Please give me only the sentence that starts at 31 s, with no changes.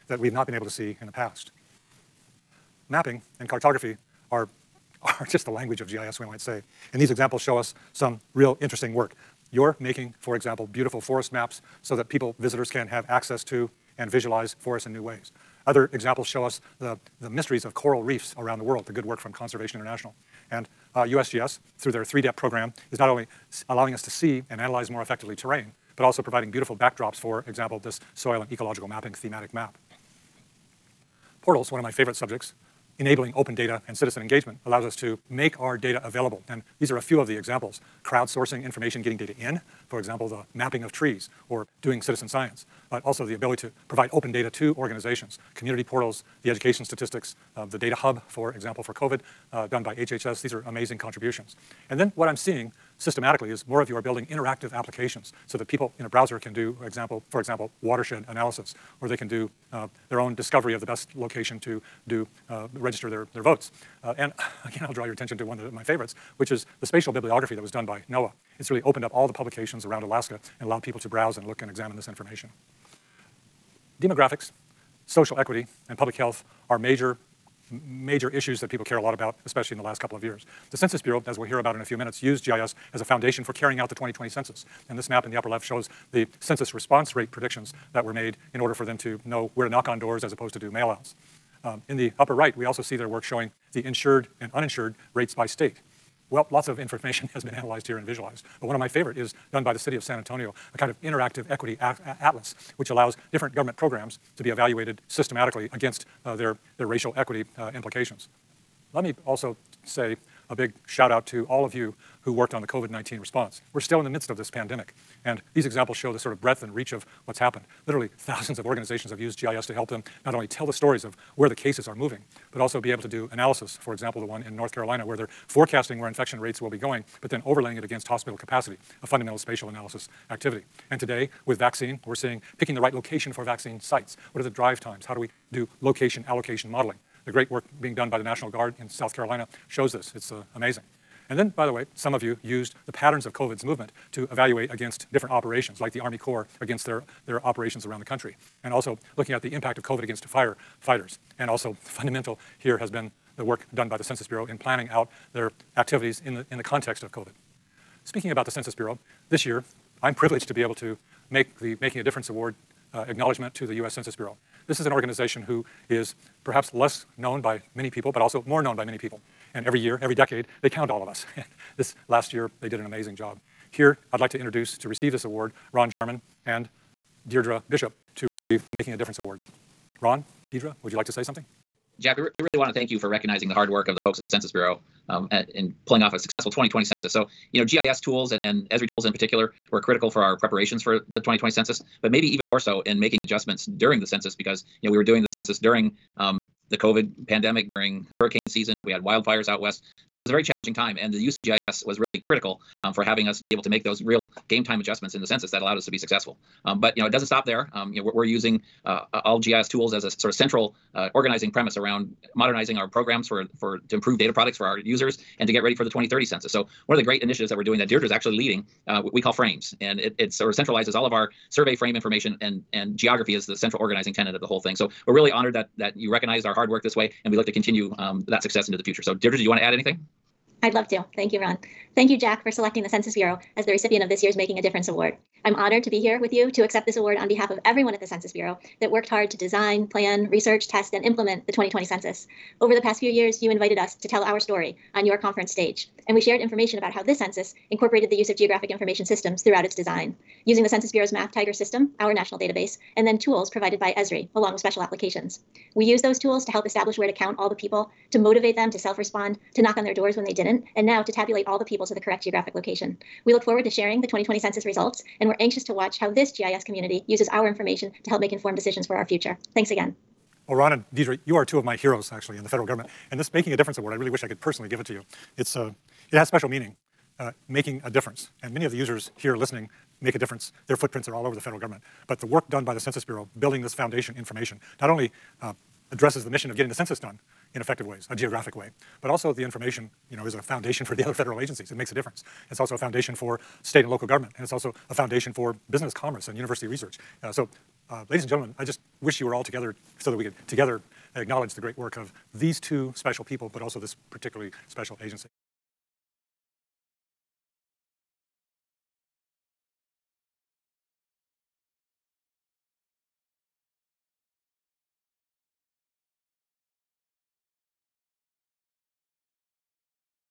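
Portals, one of my favorite subjects, enabling open data and citizen engagement allows us to make our data available.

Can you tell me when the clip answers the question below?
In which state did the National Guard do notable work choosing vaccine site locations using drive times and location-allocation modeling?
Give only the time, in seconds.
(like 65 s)
138 s.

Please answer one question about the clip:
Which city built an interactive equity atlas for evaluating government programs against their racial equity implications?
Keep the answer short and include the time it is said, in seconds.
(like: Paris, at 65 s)
San Antonio, at 100 s.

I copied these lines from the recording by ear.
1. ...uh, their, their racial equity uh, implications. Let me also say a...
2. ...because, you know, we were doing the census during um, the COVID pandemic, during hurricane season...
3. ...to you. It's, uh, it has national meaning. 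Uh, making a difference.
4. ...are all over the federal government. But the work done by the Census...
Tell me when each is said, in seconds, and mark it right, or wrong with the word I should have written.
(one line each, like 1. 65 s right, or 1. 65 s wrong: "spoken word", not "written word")
1. 106 s right
2. 194 s right
3. 274 s wrong: "special", not "national"
4. 281 s right.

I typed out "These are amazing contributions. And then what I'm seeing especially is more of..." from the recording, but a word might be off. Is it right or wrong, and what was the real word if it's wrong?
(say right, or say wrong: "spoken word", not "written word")
wrong: "systematically", not "especially".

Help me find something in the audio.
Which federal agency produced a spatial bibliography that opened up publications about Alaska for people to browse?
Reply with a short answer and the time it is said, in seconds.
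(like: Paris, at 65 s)
NOAA, at 68 s.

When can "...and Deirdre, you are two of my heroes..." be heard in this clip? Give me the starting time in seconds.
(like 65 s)
270 s.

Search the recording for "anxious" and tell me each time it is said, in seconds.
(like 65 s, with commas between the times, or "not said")
265 s.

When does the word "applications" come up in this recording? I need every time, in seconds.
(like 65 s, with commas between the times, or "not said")
54 s, 254 s.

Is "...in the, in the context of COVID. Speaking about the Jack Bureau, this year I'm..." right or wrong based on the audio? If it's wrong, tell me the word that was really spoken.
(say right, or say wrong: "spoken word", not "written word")
wrong: "Census", not "Jack".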